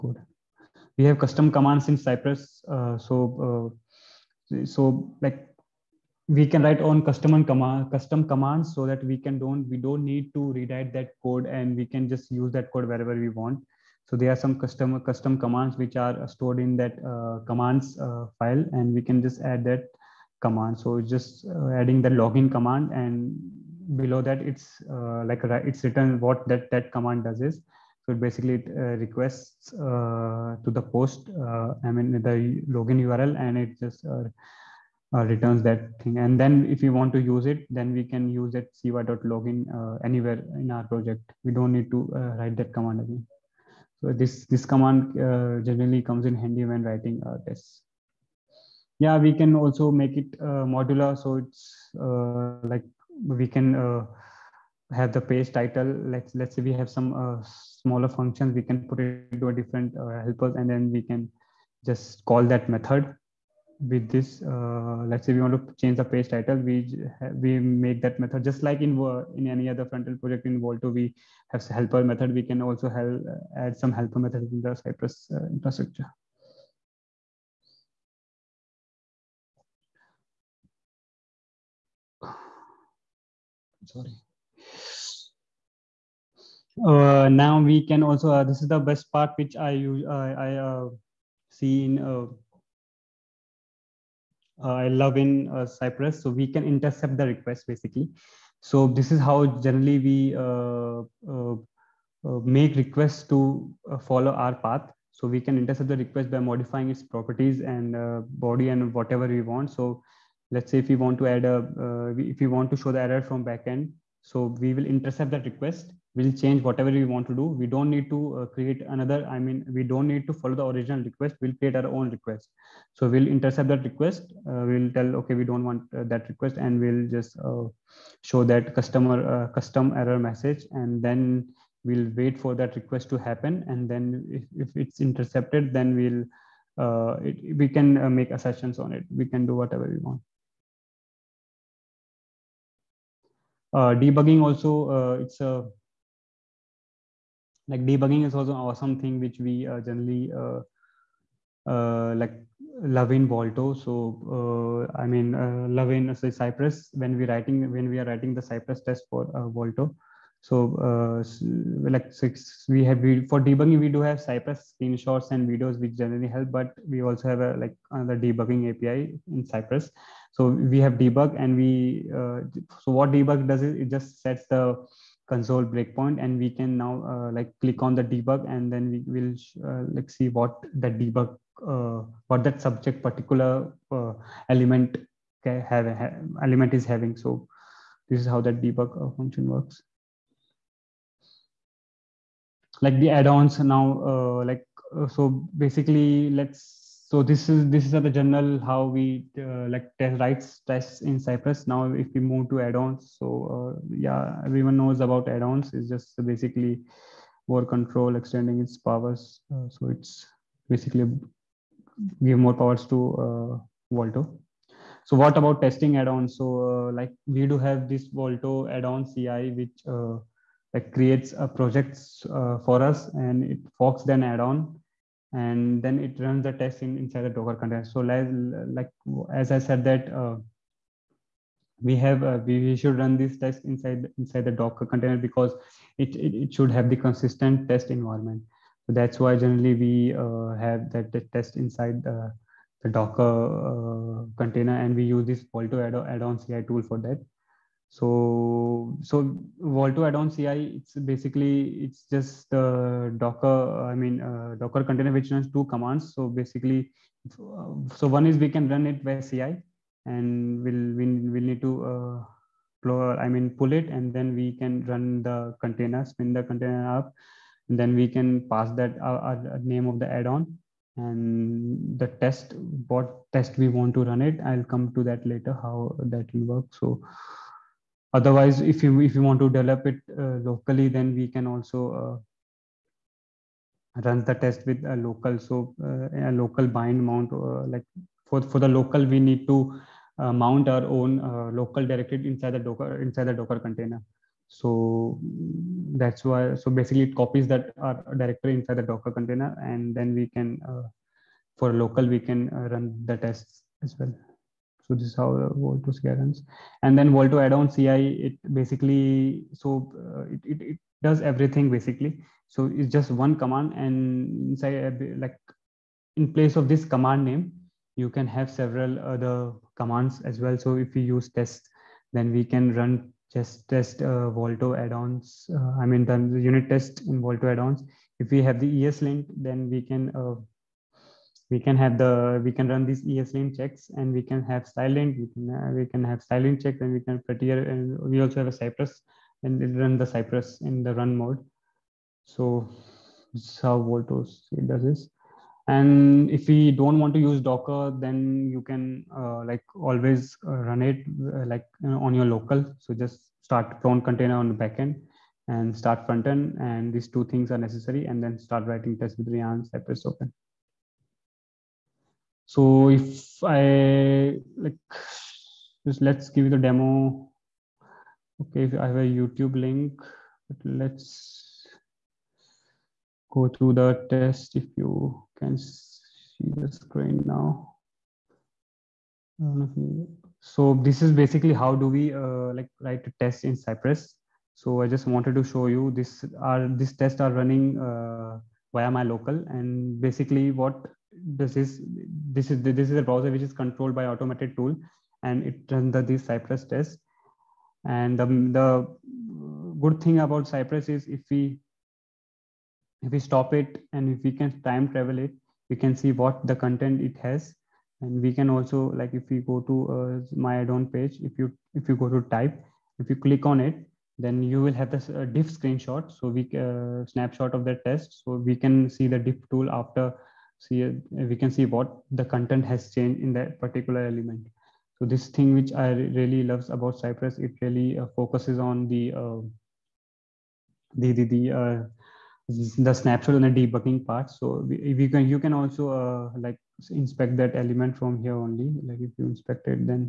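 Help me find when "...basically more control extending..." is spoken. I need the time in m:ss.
3:26.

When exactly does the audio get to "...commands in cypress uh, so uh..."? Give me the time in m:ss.
0:01.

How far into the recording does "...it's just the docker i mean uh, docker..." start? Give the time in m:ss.
4:11.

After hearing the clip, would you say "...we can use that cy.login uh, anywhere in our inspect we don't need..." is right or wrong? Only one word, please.
wrong.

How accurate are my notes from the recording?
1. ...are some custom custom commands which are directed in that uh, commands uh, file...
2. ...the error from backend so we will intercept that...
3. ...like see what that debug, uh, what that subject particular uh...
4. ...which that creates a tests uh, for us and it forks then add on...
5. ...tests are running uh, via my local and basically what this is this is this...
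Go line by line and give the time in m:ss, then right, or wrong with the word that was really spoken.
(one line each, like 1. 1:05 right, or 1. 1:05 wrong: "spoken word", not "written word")
1. 0:14 wrong: "stored", not "directed"
2. 1:52 right
3. 2:59 right
4. 3:39 wrong: "projects", not "tests"
5. 6:27 right.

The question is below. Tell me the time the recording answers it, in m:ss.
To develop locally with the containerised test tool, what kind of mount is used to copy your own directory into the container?
4:46.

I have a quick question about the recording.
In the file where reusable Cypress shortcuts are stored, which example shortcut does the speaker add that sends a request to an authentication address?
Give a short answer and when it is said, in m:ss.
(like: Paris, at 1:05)
login command, at 0:22.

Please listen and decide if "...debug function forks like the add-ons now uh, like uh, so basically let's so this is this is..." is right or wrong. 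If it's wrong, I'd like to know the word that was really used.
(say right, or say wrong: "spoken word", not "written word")
wrong: "works", not "forks".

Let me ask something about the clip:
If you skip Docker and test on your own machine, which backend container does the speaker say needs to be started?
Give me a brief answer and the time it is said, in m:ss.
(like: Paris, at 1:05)
Plone, at 5:53.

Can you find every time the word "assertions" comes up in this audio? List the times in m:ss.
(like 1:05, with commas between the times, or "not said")
2:18.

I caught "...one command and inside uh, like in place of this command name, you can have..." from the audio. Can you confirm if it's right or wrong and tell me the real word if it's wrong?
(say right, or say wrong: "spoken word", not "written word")
right.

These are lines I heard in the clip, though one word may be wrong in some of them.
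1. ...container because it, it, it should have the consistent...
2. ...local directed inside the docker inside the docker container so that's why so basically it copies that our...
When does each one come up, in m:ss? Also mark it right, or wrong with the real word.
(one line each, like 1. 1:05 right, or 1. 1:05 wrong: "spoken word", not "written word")
1. 3:54 right
2. 4:51 right.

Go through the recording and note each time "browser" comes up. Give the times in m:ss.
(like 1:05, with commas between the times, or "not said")
6:33.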